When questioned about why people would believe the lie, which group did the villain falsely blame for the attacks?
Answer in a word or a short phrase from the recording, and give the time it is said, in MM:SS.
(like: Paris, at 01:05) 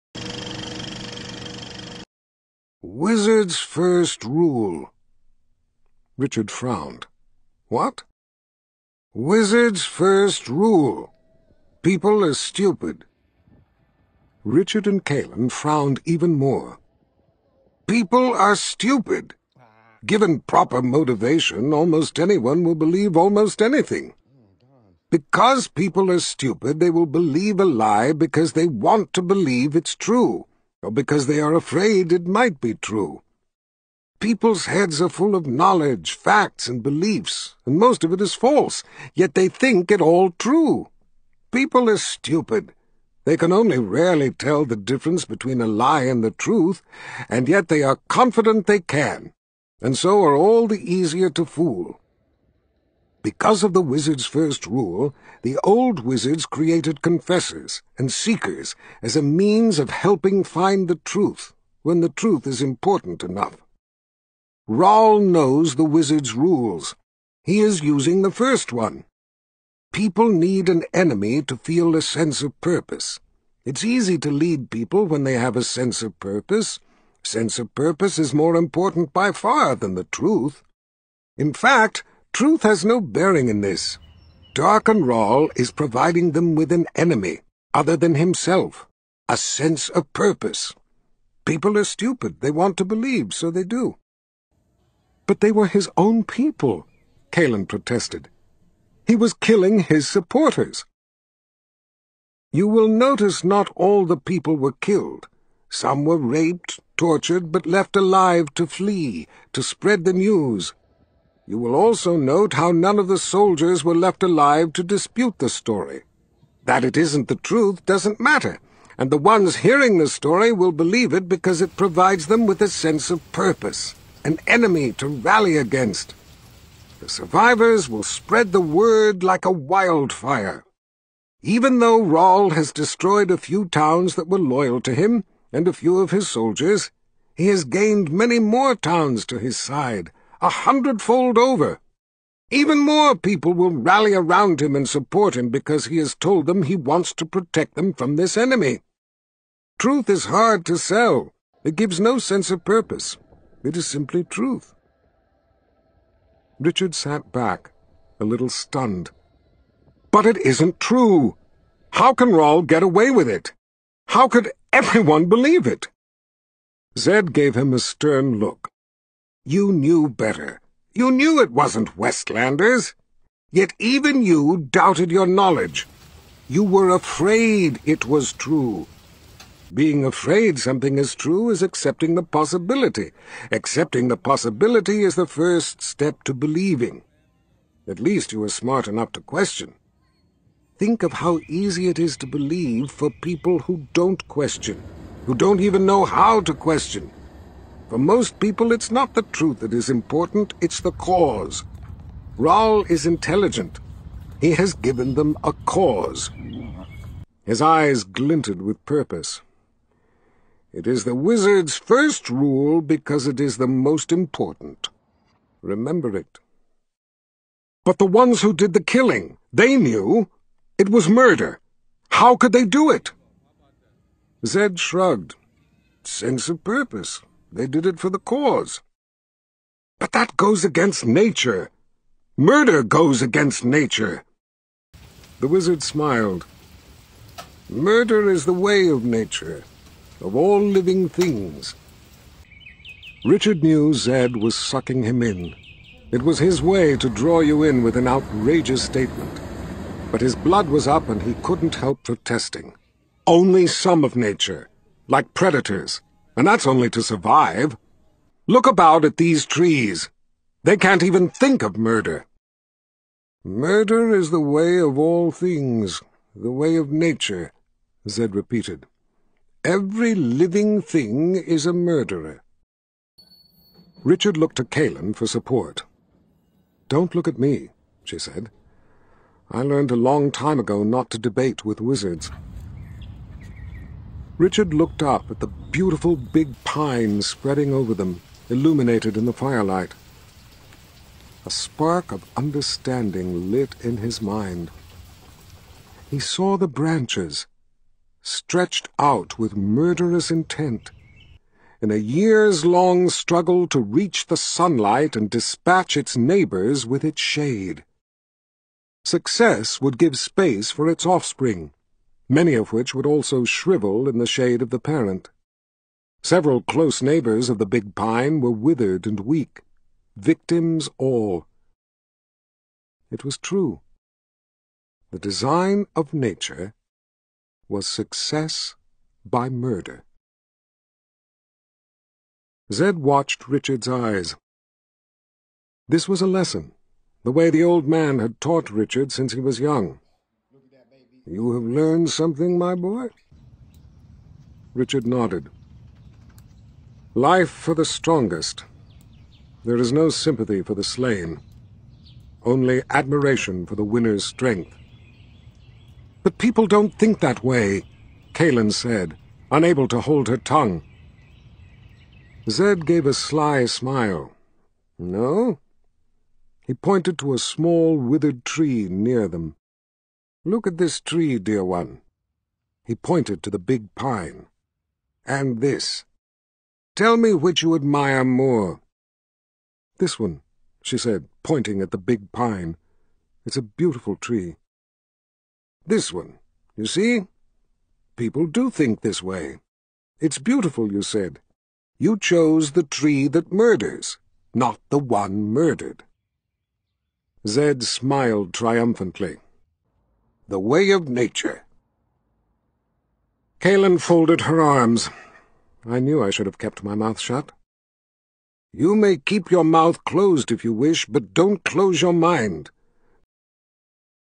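Westlanders, at 02:51.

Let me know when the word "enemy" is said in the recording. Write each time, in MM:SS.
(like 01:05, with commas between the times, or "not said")
01:10, 01:26, 02:04, 02:28.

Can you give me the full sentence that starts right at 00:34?
People's heads are full of knowledge, facts, and beliefs, and most of it is false, yet they think it all true.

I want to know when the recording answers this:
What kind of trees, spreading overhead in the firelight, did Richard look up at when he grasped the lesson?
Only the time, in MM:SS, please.
04:46.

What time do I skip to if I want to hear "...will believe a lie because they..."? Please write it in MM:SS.
00:26.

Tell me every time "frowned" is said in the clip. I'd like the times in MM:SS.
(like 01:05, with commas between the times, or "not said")
00:06, 00:15.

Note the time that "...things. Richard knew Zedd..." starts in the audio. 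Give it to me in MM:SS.
04:01.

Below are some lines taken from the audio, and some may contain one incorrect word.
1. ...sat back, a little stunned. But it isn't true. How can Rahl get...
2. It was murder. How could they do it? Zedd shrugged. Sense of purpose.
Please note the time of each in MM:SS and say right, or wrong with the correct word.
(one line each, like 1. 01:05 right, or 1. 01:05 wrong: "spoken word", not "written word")
1. 02:36 right
2. 03:40 right.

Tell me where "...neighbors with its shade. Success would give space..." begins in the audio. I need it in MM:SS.
05:06.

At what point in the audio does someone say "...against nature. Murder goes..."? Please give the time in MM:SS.
03:50.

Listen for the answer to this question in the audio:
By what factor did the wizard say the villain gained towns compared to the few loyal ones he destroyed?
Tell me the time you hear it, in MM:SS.
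02:20.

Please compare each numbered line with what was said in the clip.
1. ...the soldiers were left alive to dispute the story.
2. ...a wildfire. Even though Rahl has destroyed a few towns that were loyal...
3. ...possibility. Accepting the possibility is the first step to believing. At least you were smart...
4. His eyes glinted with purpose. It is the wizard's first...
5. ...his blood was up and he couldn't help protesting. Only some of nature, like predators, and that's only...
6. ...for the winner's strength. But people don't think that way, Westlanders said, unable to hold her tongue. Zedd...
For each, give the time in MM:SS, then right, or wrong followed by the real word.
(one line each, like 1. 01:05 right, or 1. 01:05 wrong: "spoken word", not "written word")
1. 01:53 right
2. 02:09 right
3. 03:02 right
4. 03:27 right
5. 04:10 right
6. 05:53 wrong: "Kahlan", not "Westlanders".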